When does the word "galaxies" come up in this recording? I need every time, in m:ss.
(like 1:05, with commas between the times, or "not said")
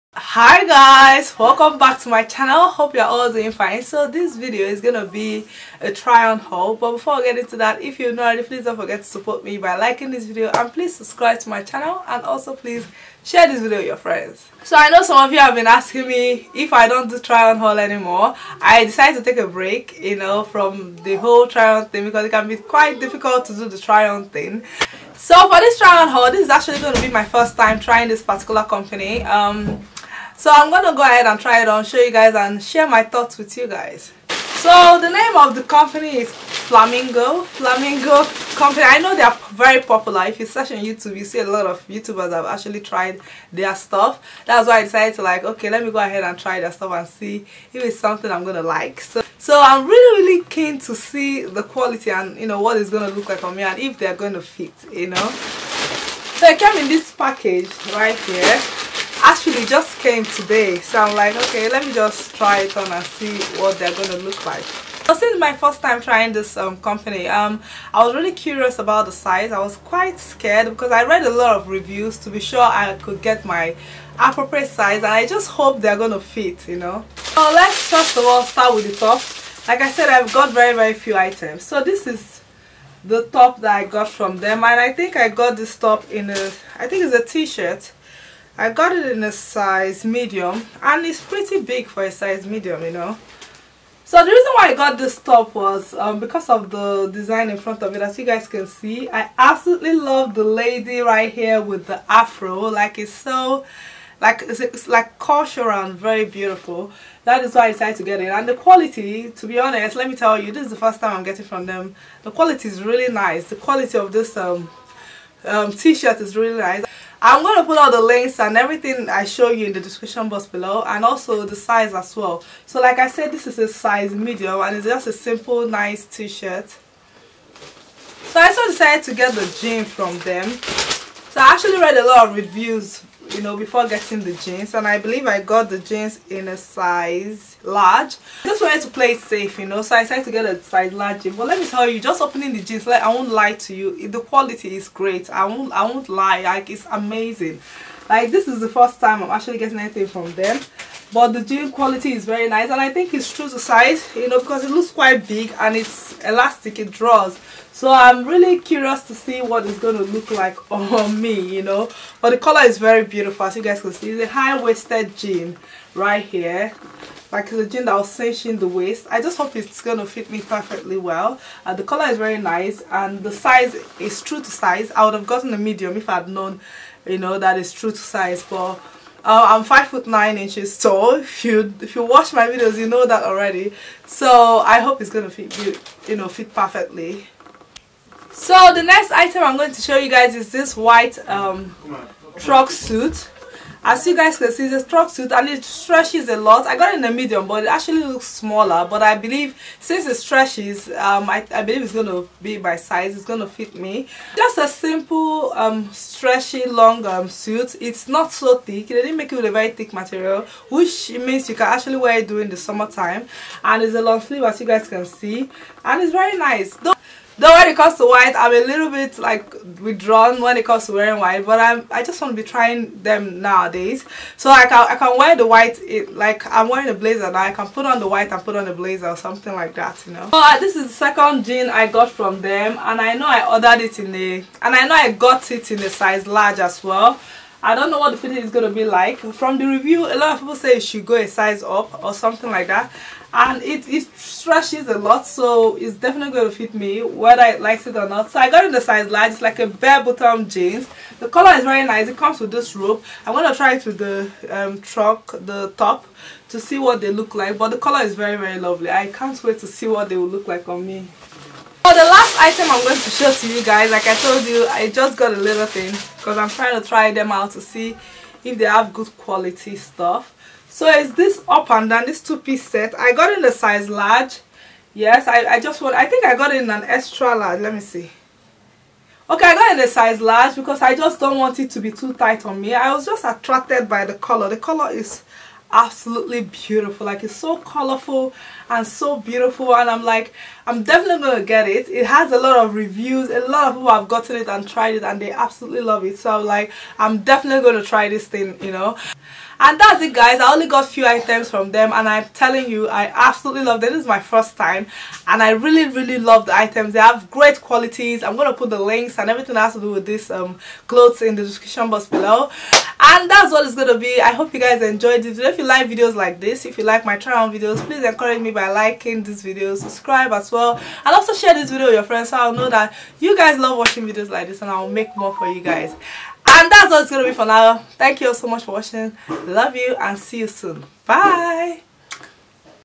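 not said.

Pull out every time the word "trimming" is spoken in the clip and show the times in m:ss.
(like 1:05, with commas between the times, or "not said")
not said.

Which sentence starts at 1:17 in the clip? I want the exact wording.
So let's first of all start with the top.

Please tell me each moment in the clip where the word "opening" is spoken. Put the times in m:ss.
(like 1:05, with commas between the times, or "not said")
2:22.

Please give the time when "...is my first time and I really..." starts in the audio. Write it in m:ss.
5:04.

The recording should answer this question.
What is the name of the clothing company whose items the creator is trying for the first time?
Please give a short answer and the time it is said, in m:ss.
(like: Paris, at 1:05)
Flamingo, at 0:34.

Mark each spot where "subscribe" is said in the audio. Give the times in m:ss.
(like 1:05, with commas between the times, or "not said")
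0:10, 5:19.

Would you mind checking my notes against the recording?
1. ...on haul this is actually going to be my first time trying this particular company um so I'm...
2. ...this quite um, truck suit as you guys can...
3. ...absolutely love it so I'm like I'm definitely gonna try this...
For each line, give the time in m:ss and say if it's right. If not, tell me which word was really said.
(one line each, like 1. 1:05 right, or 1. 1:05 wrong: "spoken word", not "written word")
1. 0:26 right
2. 3:10 wrong: "white", not "quite"
3. 4:55 right.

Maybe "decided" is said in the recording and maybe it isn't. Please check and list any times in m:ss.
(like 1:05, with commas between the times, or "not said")
0:18, 0:44, 1:47, 2:08, 2:20.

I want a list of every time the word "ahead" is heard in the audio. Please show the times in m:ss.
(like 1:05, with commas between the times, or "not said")
0:31, 0:45.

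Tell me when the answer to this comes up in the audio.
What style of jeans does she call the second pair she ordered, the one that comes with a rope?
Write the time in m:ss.
4:09.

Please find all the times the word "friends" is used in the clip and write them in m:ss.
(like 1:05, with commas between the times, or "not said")
0:13, 5:22.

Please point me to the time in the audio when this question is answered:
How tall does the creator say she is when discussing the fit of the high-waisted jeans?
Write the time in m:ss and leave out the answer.
2:59.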